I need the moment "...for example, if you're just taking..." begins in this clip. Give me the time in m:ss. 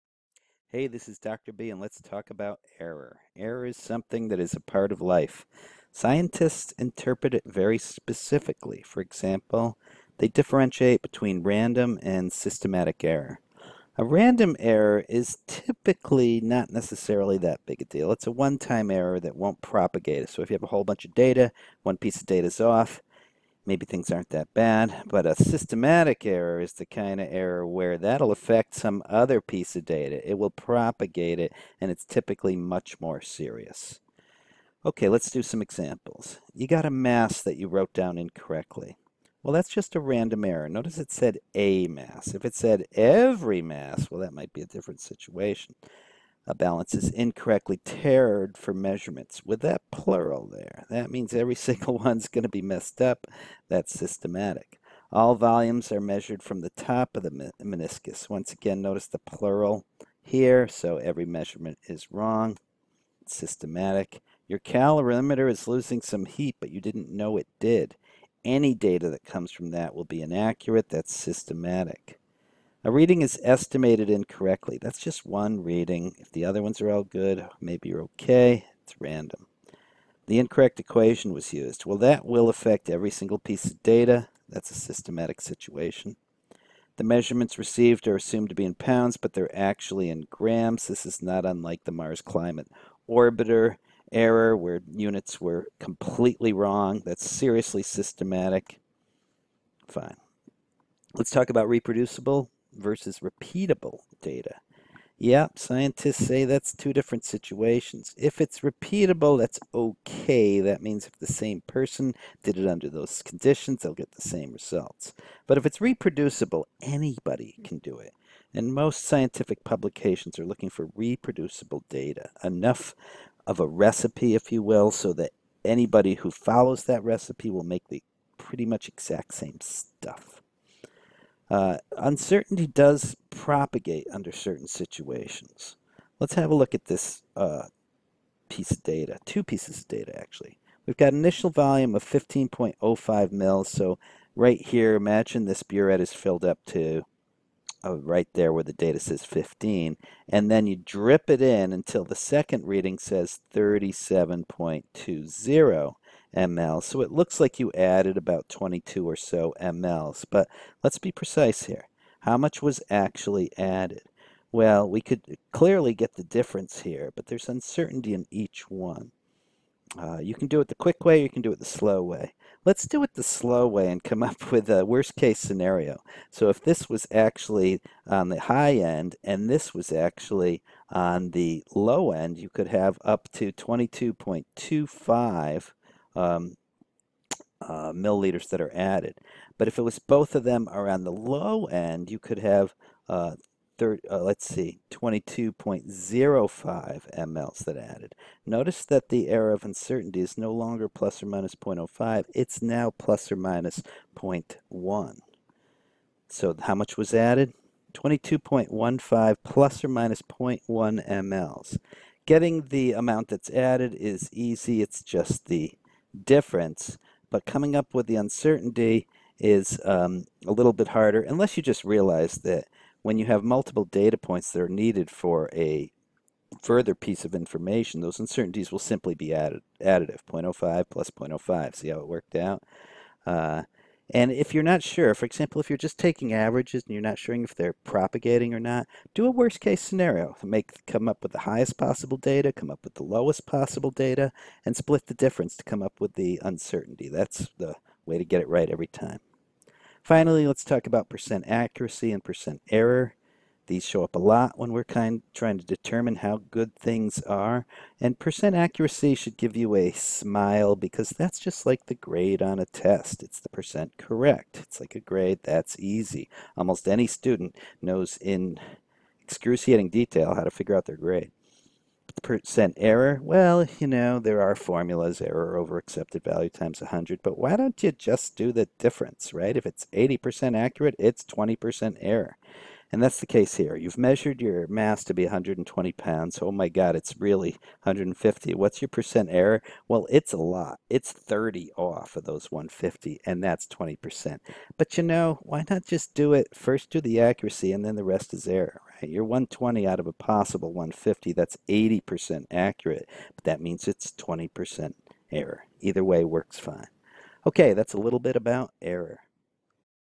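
3:55.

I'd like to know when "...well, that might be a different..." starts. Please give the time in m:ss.
0:44.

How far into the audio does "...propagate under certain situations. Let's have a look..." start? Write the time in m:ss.
2:13.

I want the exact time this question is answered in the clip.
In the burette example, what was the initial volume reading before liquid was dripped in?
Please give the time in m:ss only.
2:22.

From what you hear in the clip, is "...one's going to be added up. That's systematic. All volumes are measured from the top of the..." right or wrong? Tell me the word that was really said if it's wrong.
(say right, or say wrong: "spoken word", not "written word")
wrong: "messed", not "added".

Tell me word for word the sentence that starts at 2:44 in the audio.
Well, we could clearly get the difference here, but there's uncertainty in each one.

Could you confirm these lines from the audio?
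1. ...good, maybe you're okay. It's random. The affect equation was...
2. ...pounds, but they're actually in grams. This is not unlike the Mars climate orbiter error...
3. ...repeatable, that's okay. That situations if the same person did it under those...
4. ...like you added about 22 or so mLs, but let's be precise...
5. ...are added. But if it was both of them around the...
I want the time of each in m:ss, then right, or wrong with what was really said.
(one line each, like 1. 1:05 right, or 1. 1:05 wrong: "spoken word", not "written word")
1. 1:17 wrong: "incorrect", not "affect"
2. 1:28 right
3. 1:48 wrong: "means", not "situations"
4. 2:37 right
5. 3:08 right.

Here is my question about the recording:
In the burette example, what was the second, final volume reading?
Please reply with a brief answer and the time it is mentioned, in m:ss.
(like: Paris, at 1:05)
37.20 mL, at 2:33.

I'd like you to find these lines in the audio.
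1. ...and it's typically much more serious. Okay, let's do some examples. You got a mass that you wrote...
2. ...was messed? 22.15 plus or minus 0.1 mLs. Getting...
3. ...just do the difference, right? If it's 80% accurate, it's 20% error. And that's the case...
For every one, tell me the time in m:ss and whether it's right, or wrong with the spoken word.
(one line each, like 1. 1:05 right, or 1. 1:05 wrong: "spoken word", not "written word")
1. 0:31 right
2. 3:26 wrong: "added", not "messed"
3. 4:37 right.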